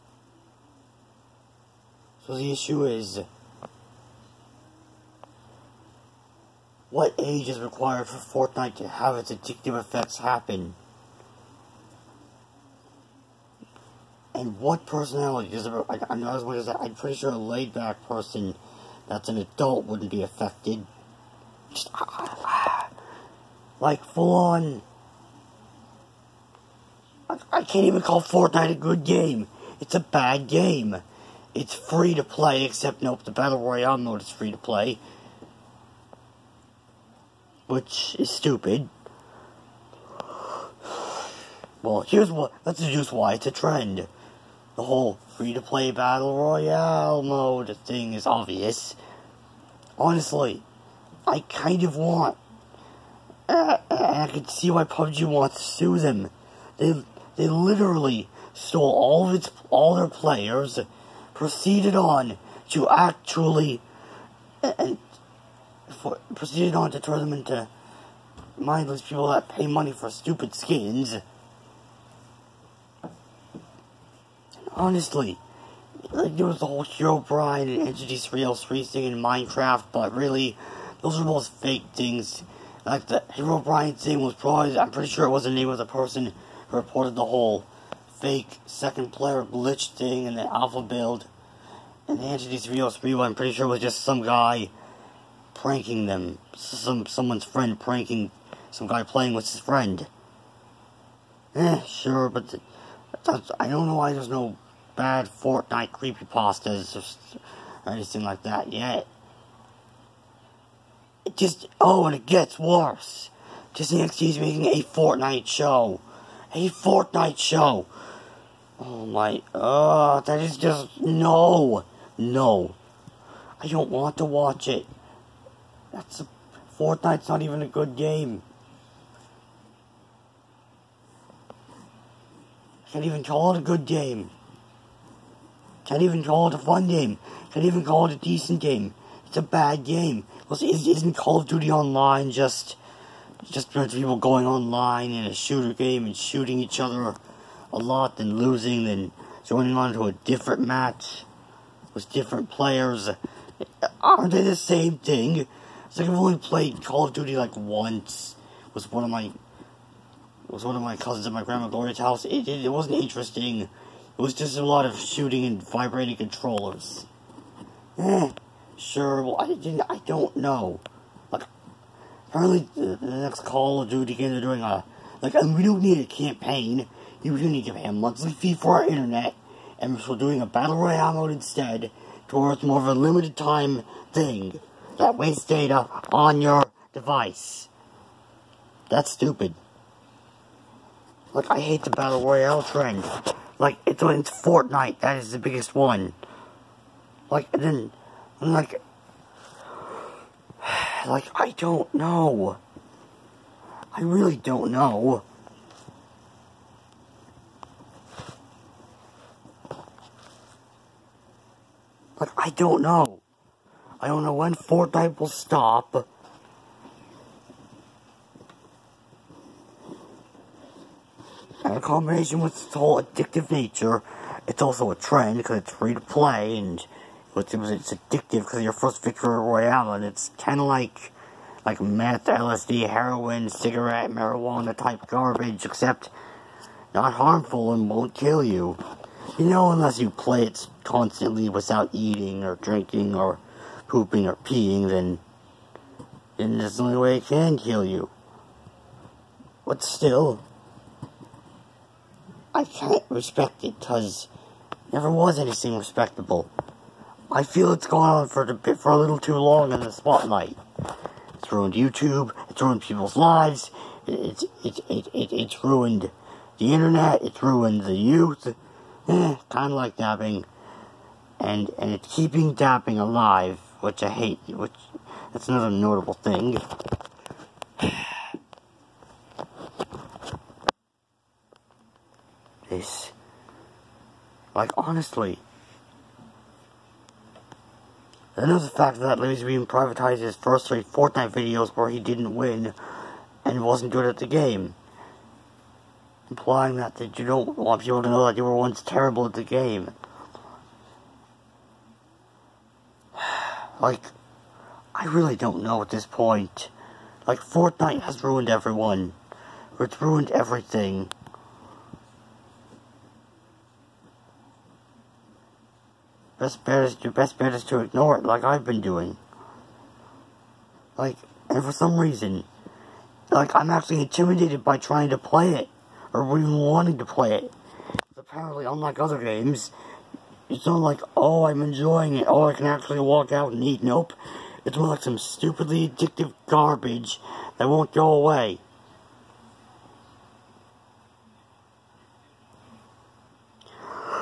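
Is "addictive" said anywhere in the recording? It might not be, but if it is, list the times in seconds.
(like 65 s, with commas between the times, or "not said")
9 s, 223 s, 227 s, 335 s.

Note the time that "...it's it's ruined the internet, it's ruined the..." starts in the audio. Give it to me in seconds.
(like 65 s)
264 s.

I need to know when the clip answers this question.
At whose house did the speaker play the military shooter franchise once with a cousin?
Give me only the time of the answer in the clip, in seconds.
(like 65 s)
161 s.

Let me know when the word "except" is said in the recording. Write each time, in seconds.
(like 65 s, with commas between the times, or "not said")
32 s, 235 s.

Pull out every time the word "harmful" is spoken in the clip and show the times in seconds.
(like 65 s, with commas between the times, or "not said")
237 s.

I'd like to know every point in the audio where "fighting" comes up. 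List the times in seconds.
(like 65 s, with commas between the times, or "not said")
not said.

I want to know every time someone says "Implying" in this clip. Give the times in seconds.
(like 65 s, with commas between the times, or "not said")
296 s.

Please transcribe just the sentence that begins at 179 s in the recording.
And we're doing a Battle Royale mode instead, towards more of a limited time thing that waste data on your device.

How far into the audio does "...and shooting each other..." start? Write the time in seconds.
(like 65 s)
146 s.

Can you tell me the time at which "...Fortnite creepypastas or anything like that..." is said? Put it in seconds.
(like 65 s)
105 s.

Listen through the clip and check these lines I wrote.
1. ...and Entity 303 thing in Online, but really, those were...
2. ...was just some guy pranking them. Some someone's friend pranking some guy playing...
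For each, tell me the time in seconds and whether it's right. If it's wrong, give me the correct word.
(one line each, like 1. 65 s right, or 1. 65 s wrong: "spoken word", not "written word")
1. 77 s wrong: "Minecraft", not "Online"
2. 93 s right.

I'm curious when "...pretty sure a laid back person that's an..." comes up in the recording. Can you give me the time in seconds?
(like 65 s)
16 s.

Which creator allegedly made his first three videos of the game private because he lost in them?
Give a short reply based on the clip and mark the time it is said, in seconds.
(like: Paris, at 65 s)
Larry, at 289 s.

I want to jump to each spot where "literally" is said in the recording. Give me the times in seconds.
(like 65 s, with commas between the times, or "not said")
57 s.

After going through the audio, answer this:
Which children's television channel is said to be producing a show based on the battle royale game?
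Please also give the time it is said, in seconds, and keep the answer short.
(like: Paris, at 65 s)
Disney XD, at 113 s.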